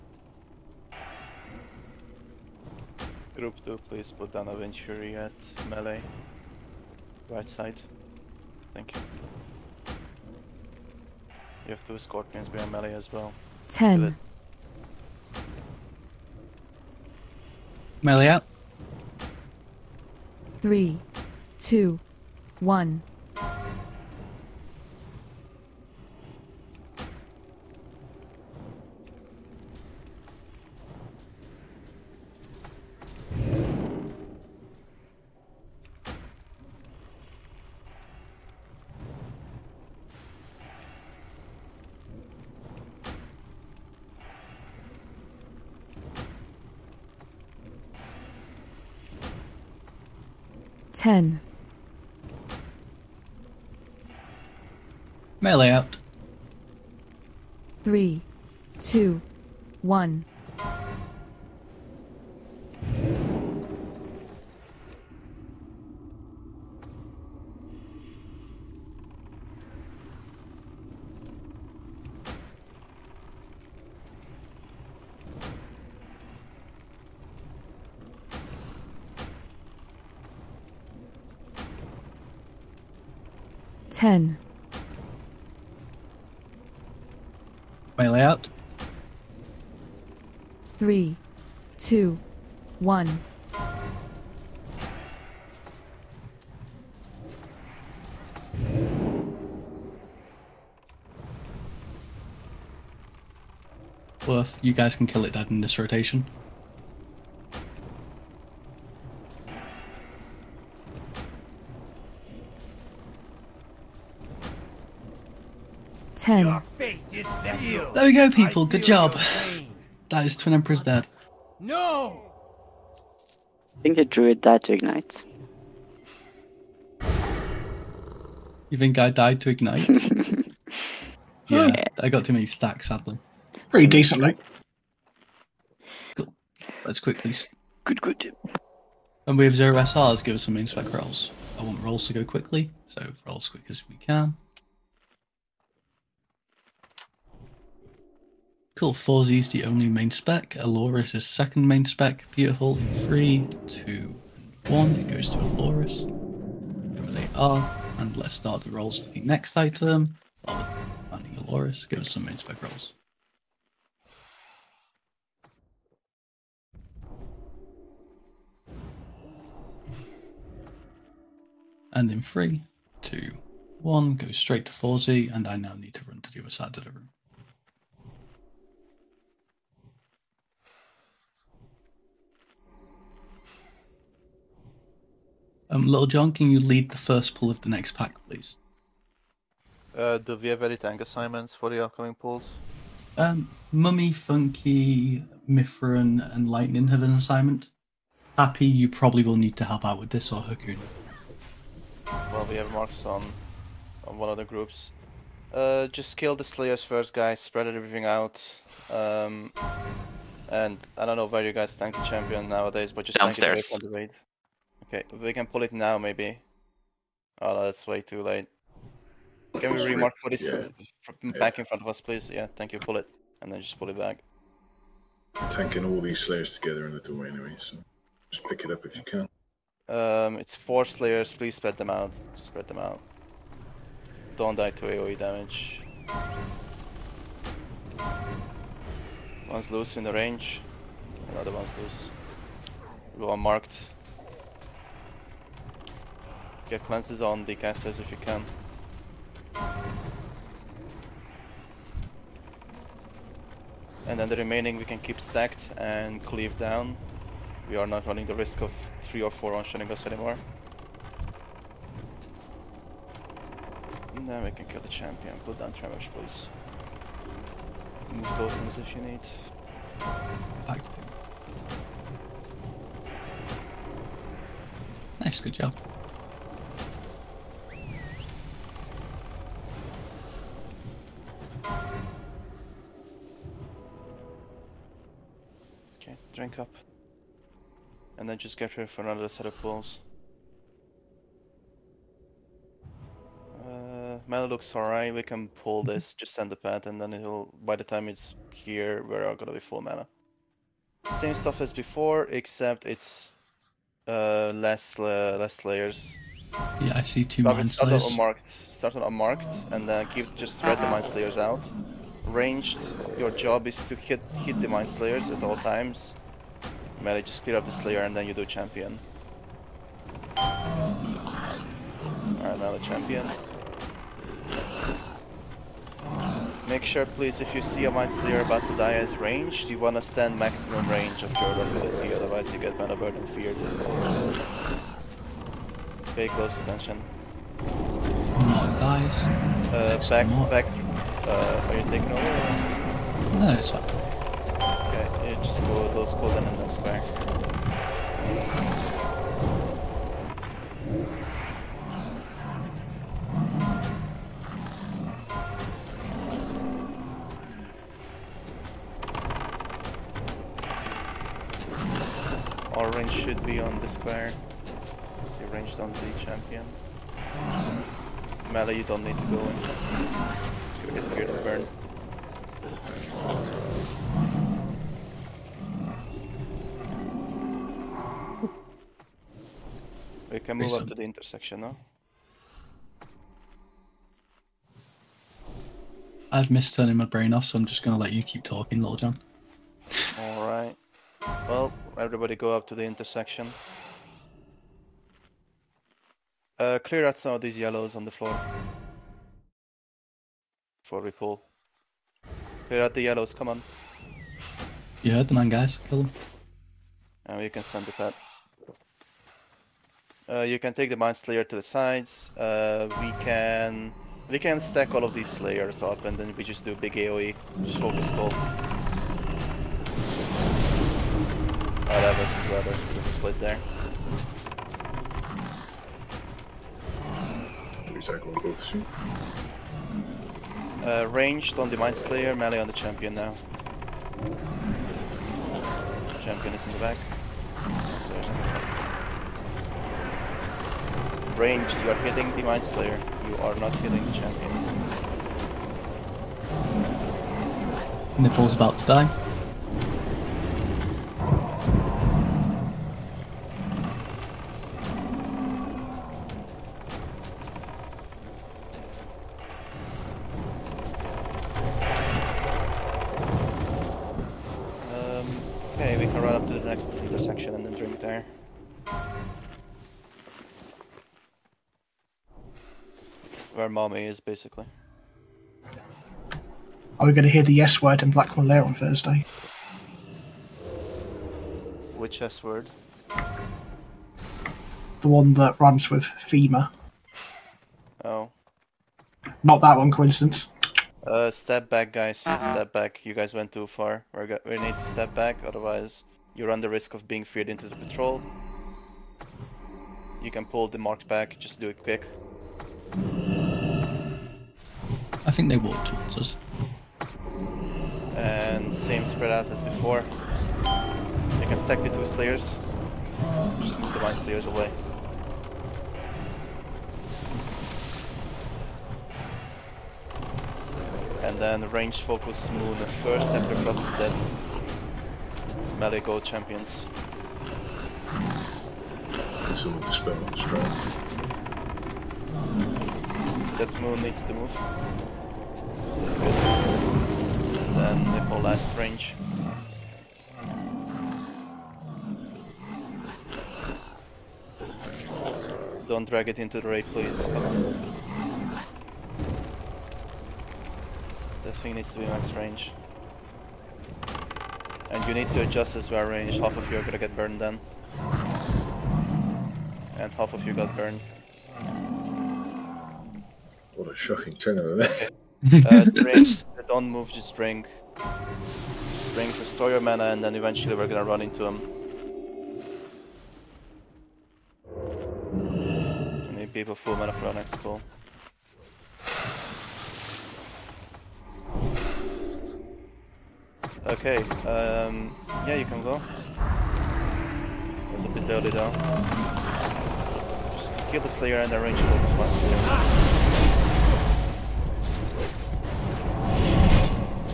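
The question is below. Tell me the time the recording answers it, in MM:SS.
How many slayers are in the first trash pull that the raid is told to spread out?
03:50.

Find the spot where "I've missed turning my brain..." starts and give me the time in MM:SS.
06:26.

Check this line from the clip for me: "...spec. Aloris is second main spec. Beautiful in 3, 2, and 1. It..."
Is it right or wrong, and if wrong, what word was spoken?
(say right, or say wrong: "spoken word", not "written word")
right.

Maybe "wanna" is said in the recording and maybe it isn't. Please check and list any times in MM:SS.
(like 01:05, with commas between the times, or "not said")
05:29.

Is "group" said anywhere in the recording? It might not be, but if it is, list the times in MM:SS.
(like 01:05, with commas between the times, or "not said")
00:03, 03:24.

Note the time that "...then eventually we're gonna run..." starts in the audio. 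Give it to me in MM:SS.
09:30.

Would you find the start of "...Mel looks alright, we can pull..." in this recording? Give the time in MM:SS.
04:54.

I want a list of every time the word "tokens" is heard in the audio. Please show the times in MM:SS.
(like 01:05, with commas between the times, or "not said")
04:28.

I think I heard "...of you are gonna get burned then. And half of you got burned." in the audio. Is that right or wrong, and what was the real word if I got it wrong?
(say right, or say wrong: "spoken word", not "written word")
right.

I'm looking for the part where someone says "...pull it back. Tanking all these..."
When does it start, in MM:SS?
03:43.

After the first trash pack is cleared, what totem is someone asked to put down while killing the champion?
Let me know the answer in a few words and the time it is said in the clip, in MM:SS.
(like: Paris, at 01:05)
Tremors, at 04:25.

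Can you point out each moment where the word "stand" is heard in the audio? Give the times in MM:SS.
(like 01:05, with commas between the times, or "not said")
05:30.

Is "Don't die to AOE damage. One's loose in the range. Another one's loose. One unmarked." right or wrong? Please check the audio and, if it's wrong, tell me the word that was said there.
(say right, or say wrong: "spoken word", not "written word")
wrong: "marked", not "unmarked".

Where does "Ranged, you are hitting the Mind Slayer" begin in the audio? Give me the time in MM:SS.
07:21.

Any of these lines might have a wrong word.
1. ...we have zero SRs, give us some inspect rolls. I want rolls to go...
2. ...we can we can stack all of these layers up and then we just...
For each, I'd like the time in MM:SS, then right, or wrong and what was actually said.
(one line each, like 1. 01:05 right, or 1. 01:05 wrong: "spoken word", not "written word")
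1. 02:19 right
2. 06:53 right.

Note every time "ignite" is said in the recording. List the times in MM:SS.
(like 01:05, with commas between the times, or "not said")
02:04, 02:09.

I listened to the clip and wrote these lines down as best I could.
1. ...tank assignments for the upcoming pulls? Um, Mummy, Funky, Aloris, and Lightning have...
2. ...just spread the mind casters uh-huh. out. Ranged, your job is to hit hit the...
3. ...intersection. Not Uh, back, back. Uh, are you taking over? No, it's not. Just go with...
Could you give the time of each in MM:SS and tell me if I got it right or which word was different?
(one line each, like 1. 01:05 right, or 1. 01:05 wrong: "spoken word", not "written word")
1. 03:10 wrong: "Mithrin", not "Aloris"
2. 05:10 wrong: "slayers", not "casters"
3. 05:36 wrong: "attention", not "intersection".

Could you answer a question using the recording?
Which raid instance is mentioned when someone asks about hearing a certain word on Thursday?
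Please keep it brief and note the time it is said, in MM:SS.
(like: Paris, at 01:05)
Blackwing Lair, at 07:58.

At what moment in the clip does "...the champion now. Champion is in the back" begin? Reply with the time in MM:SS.
07:12.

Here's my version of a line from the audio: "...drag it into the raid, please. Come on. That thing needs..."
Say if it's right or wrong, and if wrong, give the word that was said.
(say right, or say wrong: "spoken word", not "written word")
right.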